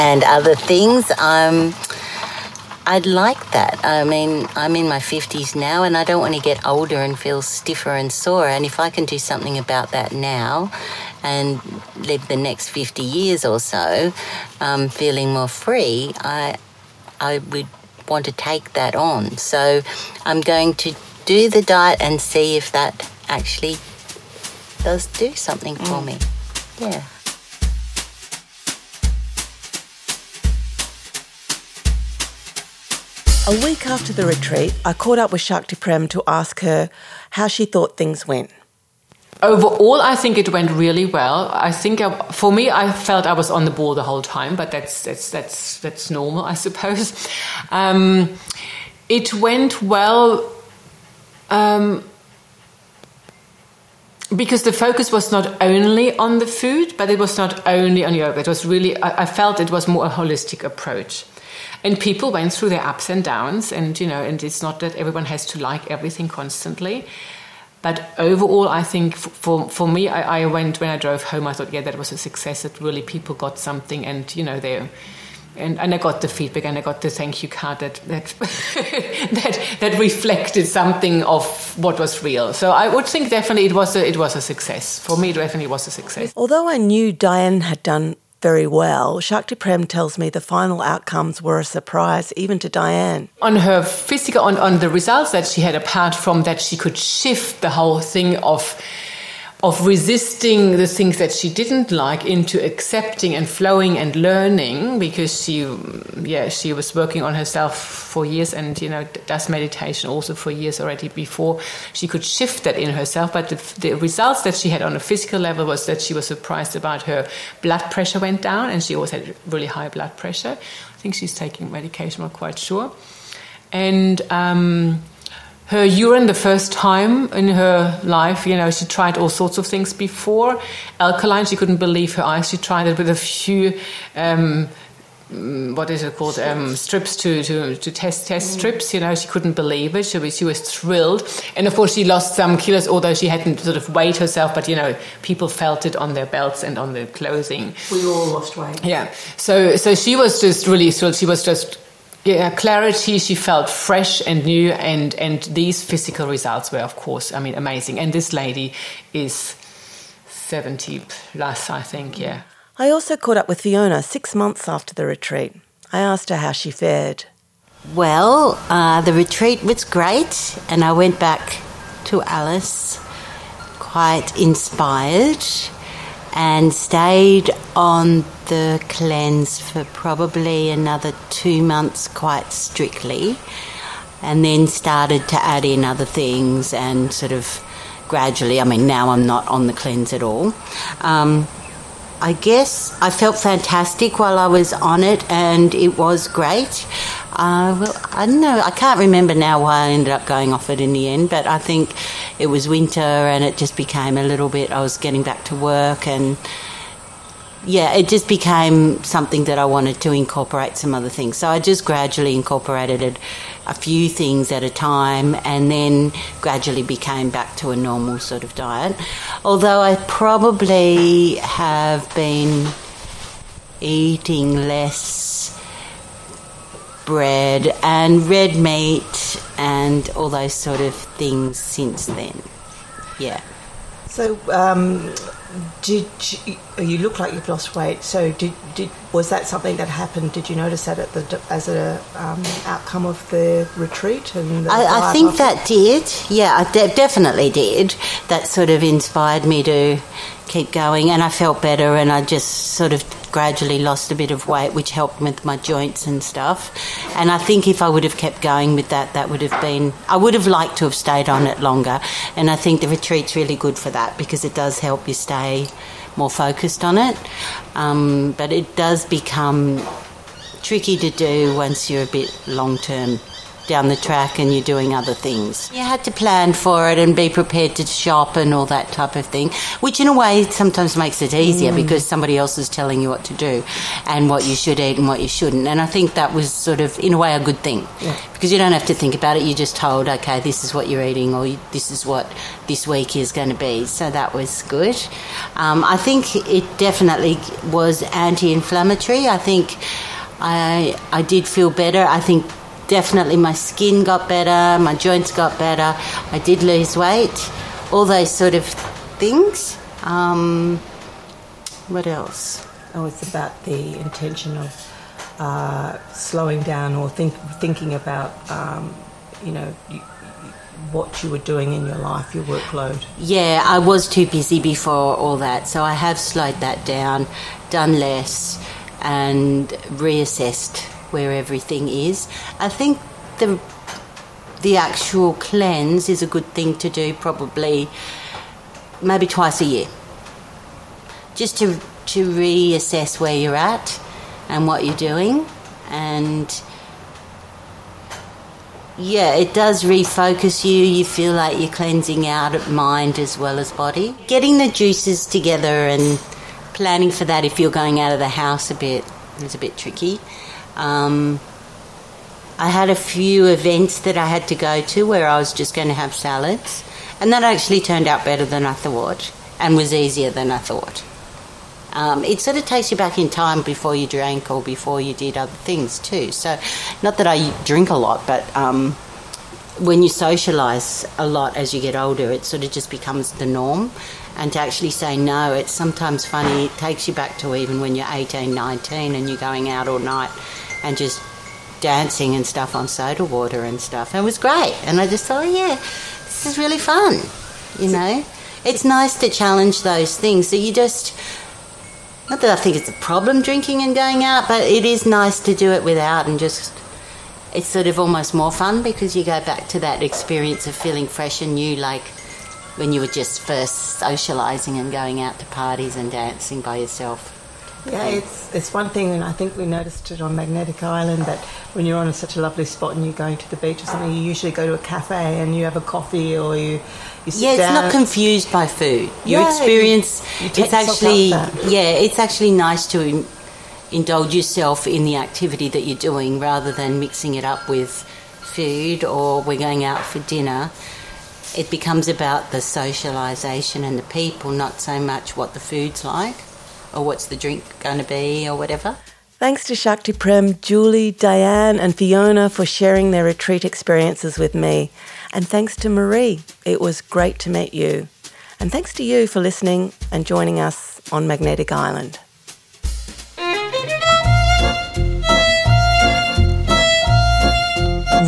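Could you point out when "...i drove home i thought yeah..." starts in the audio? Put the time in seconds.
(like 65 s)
70 s.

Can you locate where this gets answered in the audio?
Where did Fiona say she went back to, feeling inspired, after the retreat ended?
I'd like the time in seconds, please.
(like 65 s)
172 s.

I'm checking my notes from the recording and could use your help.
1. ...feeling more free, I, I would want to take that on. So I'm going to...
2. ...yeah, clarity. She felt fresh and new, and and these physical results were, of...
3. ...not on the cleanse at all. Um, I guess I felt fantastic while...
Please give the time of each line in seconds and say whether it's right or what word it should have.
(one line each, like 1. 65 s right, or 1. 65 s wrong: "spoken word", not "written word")
1. 14 s right
2. 152 s right
3. 189 s right.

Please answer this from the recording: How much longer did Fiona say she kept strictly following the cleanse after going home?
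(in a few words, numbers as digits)
2 months.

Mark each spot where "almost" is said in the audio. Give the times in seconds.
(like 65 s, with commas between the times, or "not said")
407 s.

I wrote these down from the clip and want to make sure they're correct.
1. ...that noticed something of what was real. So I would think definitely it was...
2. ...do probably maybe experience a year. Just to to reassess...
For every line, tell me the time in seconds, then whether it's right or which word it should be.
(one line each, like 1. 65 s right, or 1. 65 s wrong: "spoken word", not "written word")
1. 79 s wrong: "reflected", not "noticed"
2. 336 s wrong: "twice", not "experience".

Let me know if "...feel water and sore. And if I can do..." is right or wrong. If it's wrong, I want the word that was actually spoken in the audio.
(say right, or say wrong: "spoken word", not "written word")
wrong: "stiffer", not "water".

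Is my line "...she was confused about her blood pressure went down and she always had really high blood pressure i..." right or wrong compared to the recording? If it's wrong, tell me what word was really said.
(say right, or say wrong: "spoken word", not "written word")
wrong: "surprised", not "confused".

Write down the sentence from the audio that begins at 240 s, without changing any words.
Did you notice that at the as a um, outcome of the retreat?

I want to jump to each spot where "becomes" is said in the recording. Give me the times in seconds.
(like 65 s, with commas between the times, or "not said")
269 s, 382 s, 441 s.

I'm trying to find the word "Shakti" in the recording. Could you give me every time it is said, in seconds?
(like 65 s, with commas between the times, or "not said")
35 s, 89 s, 449 s.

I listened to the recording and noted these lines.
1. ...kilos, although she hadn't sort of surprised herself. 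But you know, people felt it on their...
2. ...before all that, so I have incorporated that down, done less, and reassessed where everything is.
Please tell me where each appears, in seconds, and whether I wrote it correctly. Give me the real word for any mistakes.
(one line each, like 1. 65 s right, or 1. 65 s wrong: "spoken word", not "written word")
1. 142 s wrong: "weighed", not "surprised"
2. 324 s wrong: "slowed", not "incorporated".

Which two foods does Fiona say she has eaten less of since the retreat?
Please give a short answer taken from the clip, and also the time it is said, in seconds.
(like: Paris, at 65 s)
Bread and red meat, at 227 s.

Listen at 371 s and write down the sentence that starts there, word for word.
Um, it sort of takes you back in time before you drank or before you did other things too.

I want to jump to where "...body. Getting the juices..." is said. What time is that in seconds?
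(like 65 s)
353 s.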